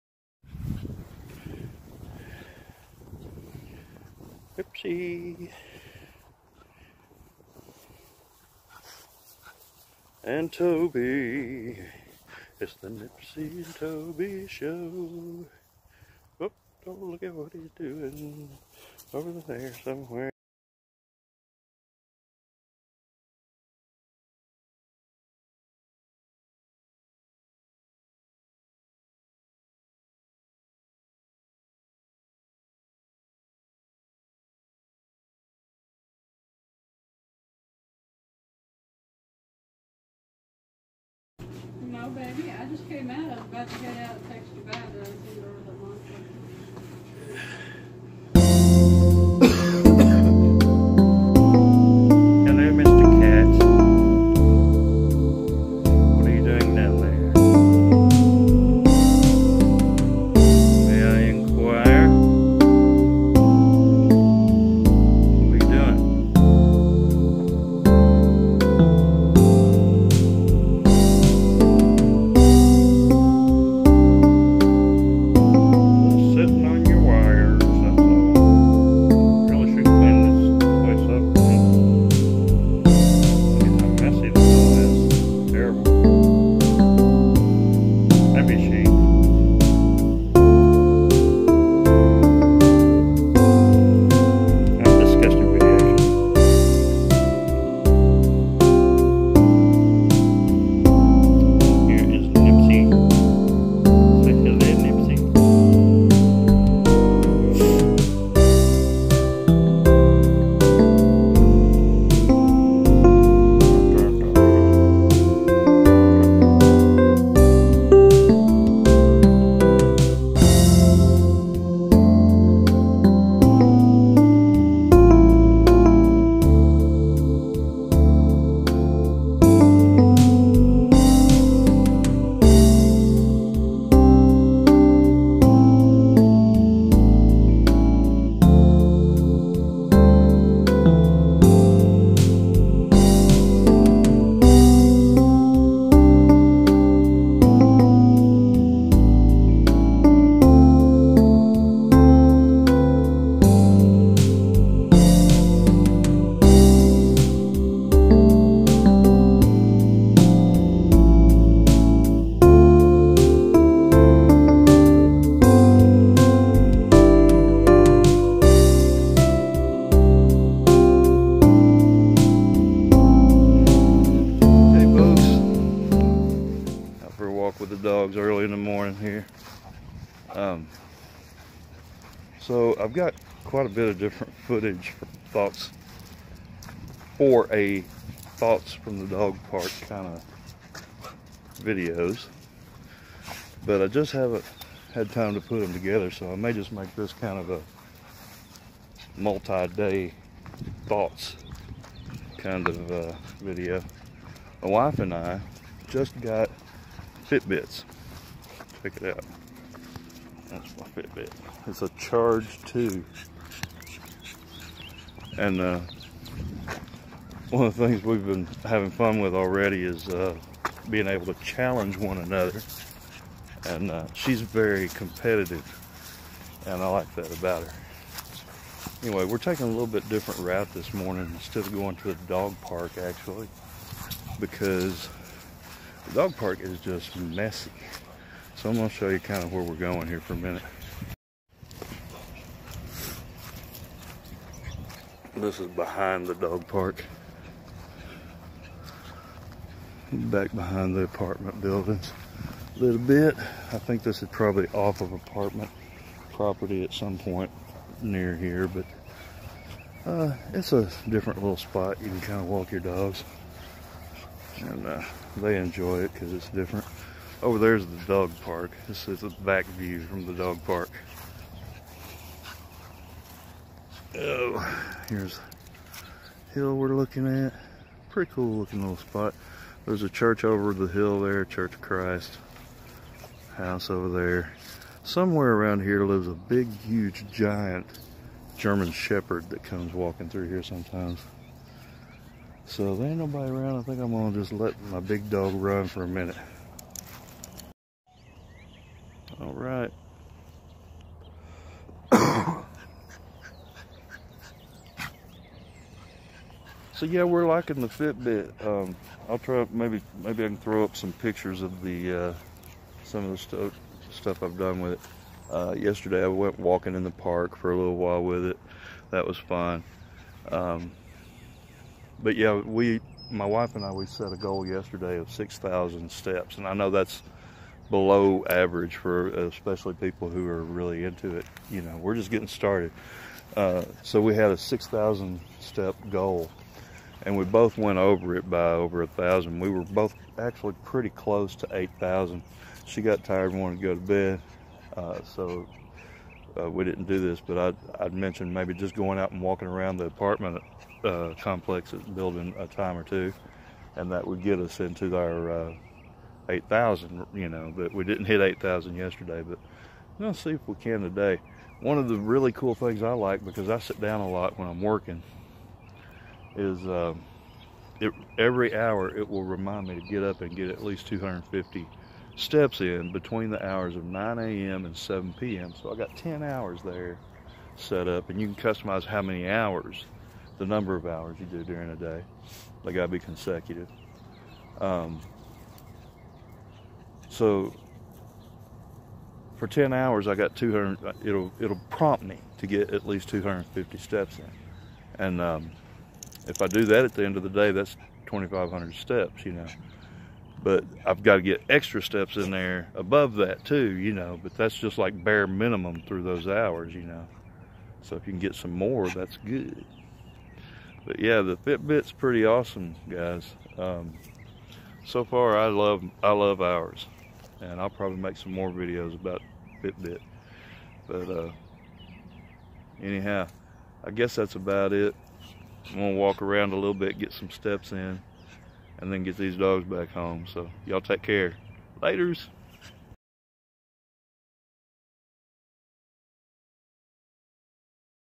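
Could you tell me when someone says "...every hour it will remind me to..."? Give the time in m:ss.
6:08.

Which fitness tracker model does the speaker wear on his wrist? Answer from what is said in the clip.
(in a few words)
Charge 2.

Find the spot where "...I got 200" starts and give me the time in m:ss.
6:30.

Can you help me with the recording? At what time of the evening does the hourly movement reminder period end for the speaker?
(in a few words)
7 p.m.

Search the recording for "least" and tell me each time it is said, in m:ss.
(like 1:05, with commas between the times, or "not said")
6:10, 6:33.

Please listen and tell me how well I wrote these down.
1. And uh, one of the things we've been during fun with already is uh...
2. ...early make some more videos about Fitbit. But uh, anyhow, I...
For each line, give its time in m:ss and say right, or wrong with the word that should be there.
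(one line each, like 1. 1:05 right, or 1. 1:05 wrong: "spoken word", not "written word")
1. 3:35 wrong: "having", not "during"
2. 6:57 wrong: "probably", not "early".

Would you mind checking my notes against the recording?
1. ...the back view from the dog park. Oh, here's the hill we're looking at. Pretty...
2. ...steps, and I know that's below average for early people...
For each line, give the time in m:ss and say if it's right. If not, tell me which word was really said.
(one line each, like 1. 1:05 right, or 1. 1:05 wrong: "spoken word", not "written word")
1. 4:29 right
2. 5:26 wrong: "especially", not "early".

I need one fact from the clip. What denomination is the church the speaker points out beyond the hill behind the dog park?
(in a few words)
Church of Christ.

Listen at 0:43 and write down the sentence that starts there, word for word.
I was about to get out and text you back, but I didn't order the monster.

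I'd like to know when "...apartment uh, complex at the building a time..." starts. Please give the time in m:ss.
5:50.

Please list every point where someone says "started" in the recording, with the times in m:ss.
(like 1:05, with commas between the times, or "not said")
5:32.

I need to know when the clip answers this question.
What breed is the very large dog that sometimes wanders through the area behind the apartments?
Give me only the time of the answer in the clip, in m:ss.
4:48.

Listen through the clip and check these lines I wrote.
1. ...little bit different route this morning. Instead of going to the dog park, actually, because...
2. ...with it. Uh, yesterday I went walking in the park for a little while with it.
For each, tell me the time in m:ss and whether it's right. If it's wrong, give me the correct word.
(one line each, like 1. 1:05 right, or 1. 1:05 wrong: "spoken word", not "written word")
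1. 3:49 right
2. 5:14 right.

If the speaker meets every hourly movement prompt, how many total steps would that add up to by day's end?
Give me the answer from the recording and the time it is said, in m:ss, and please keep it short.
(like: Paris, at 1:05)
2,500, at 6:38.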